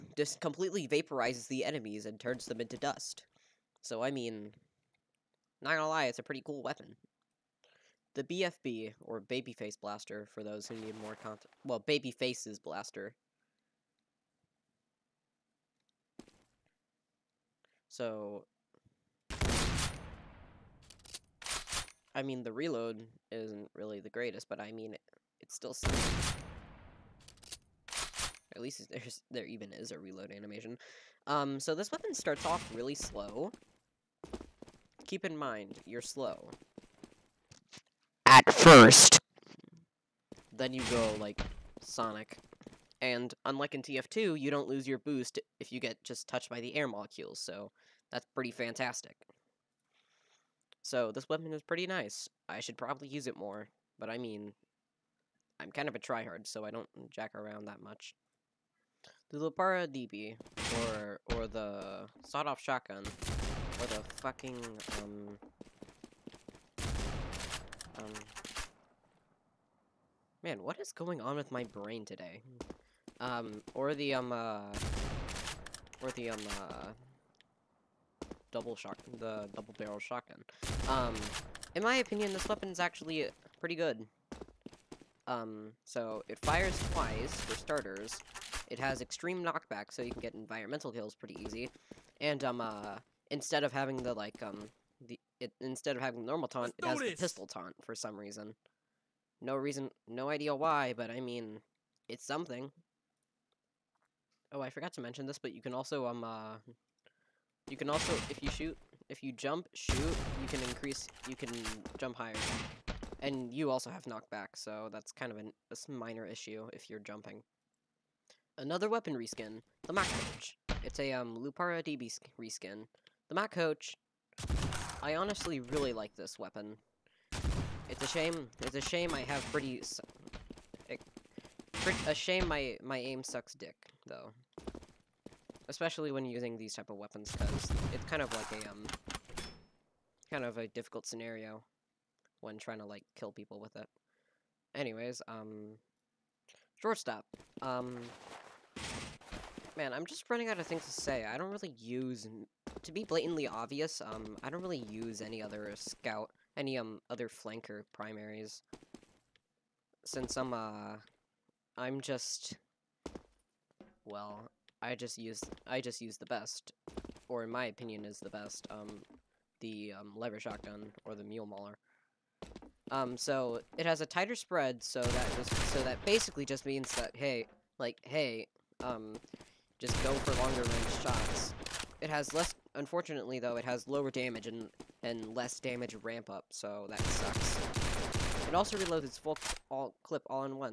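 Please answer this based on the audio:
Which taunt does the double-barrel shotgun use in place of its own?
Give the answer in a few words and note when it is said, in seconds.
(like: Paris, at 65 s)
the pistol taunt, at 97 s.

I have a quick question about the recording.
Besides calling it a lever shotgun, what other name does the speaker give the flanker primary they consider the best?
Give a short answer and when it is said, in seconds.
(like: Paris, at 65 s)
Mule Mauler, at 171 s.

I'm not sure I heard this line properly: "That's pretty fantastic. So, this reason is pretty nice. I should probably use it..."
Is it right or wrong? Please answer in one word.
wrong.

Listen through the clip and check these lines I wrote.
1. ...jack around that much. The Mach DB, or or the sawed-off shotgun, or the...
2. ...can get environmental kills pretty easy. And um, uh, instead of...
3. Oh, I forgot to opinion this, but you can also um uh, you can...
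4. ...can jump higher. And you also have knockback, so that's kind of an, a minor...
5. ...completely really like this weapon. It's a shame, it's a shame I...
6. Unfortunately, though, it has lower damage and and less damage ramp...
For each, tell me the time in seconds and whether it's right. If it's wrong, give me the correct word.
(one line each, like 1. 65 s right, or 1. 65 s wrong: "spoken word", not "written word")
1. 57 s wrong: "Lupara", not "Mach"
2. 90 s right
3. 104 s wrong: "mention", not "opinion"
4. 111 s right
5. 125 s wrong: "honestly", not "completely"
6. 182 s right.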